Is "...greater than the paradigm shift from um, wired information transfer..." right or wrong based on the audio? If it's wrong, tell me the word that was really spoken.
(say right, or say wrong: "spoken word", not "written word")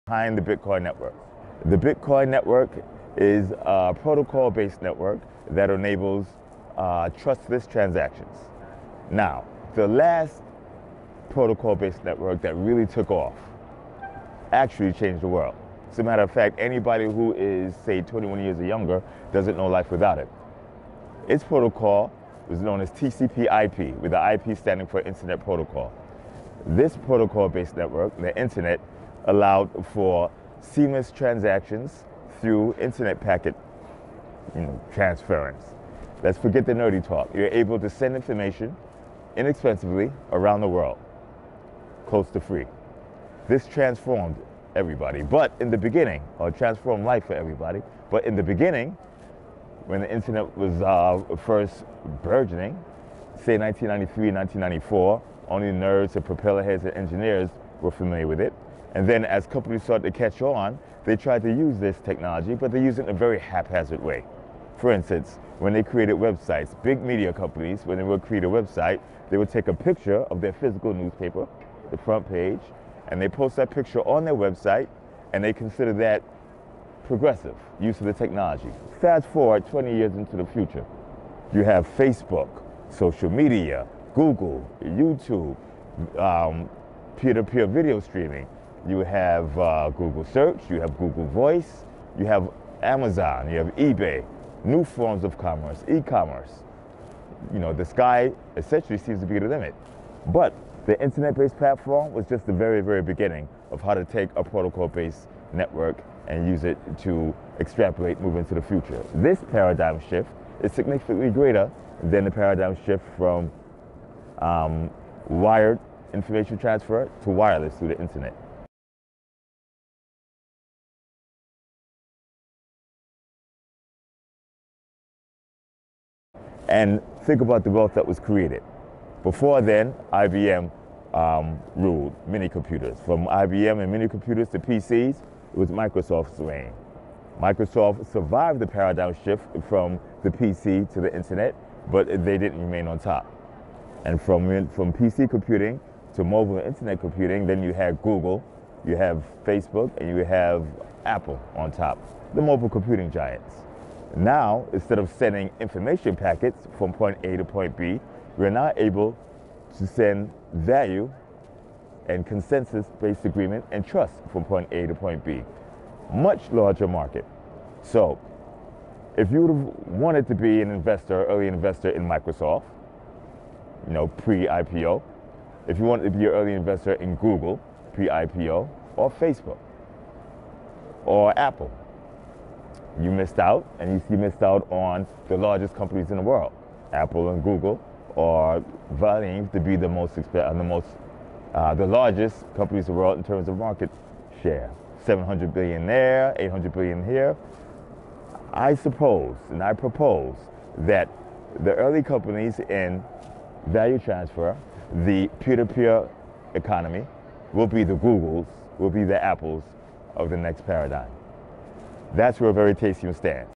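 right.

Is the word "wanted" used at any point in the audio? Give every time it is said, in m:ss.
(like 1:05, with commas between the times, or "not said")
2:49, 2:55.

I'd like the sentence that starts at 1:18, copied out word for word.
Fast forward 20 years into the future, you have Facebook, social media, Google, YouTube, peer to peer video streaming.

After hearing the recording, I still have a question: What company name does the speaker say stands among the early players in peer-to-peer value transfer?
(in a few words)
Veritaseum.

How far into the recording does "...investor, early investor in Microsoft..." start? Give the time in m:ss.
2:50.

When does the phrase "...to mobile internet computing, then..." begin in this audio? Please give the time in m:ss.
2:26.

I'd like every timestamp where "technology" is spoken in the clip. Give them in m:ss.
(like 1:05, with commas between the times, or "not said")
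1:02, 1:18.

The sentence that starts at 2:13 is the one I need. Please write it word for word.
From IBM and mini computers to PCs, it was Microsoft's reign.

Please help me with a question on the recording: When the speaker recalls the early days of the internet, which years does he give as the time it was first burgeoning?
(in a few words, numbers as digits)
1993, 1994.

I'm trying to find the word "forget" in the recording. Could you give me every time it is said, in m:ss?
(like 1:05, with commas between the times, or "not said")
0:36.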